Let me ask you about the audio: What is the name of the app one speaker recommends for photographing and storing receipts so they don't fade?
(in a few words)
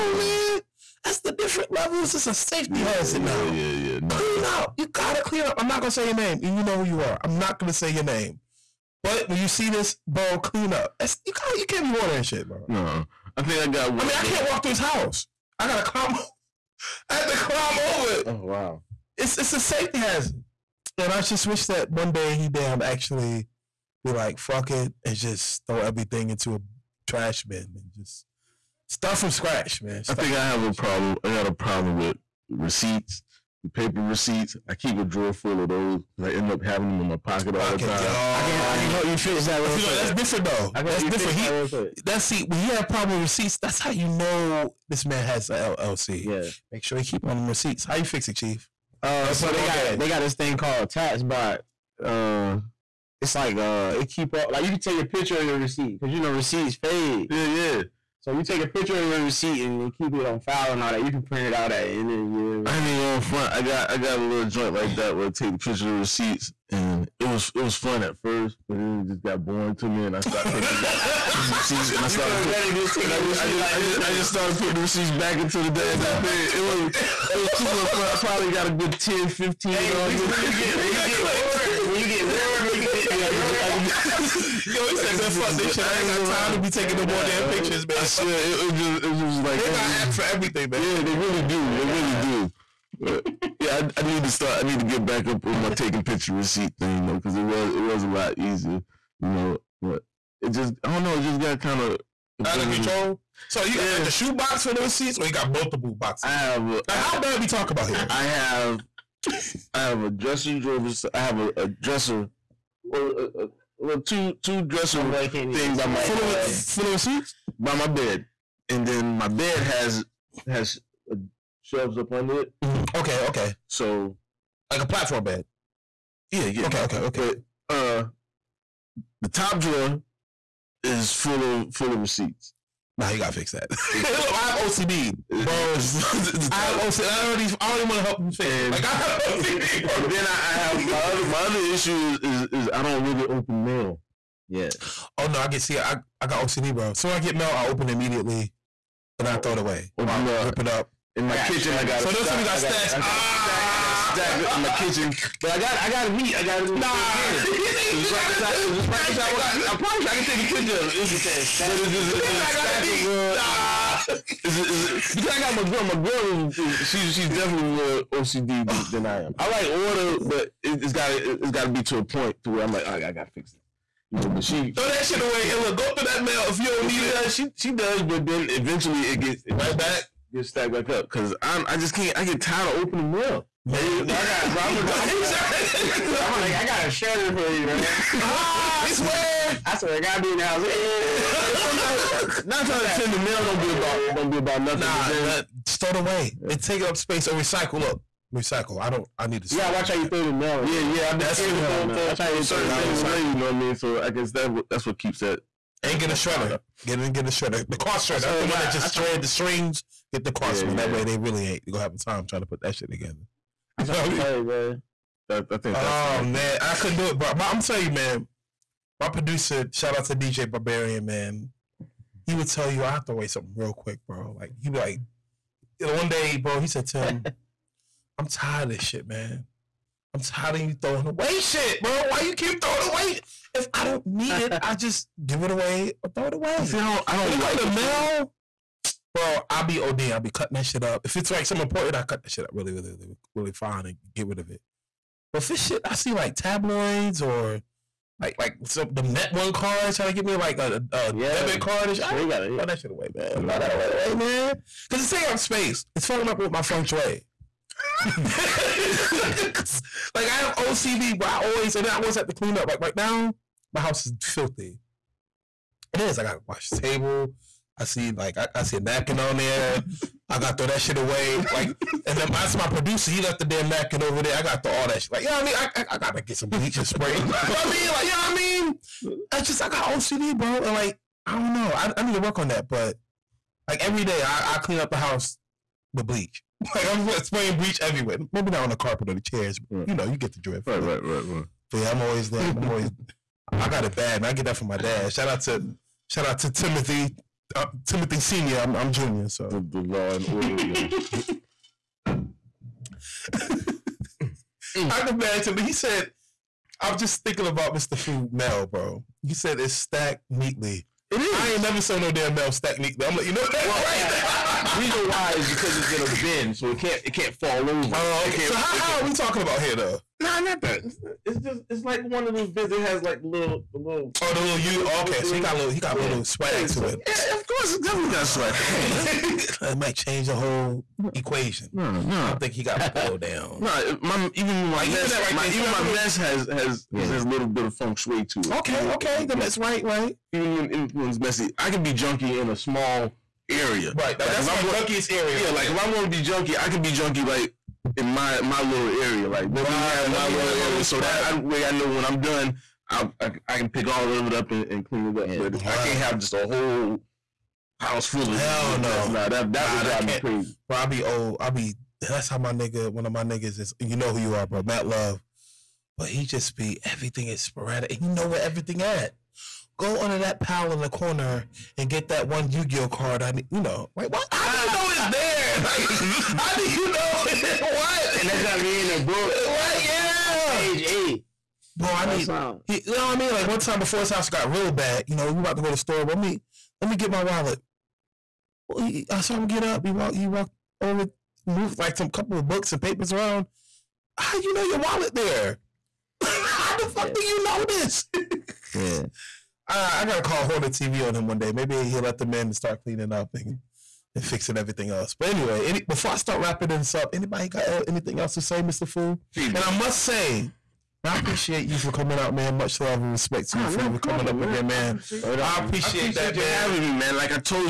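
TaxBot.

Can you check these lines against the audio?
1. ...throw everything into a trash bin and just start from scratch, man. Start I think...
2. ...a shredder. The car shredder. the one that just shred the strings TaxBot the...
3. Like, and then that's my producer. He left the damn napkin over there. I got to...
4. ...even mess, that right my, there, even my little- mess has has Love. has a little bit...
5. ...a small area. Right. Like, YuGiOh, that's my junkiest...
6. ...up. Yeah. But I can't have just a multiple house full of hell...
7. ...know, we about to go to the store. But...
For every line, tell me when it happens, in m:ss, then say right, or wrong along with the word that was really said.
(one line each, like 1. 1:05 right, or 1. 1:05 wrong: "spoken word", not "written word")
1. 0:25 right
2. 3:27 wrong: "Get", not "TaxBot"
3. 4:31 right
4. 5:34 wrong: "Yeah", not "Love"
5. 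5:42 wrong: "Like", not "YuGiOh"
6. 5:55 wrong: "whole", not "multiple"
7. 6:25 right.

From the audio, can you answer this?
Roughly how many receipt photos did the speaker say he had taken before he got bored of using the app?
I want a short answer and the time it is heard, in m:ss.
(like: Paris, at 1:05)
10, 15, at 1:18.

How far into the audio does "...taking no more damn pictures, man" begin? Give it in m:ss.
1:26.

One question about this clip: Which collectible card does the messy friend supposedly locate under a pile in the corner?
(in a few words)
Yu-Gi-Oh card.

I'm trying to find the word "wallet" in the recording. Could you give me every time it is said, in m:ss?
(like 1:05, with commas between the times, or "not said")
6:27, 6:34.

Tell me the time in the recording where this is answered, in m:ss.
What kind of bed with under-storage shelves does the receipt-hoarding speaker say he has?
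2:04.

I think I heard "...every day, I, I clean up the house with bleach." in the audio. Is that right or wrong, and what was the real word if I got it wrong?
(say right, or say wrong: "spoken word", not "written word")
right.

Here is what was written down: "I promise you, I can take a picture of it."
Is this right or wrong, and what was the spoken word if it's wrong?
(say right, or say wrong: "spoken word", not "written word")
right.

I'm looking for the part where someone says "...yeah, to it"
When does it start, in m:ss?
5:26.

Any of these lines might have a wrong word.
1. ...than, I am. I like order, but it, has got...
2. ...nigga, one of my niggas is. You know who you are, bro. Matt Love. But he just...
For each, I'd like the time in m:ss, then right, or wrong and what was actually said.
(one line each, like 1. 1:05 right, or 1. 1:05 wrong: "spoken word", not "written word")
1. 2:48 right
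2. 6:02 right.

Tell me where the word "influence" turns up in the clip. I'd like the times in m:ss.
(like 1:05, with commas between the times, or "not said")
5:40.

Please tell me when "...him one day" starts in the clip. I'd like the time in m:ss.
6:41.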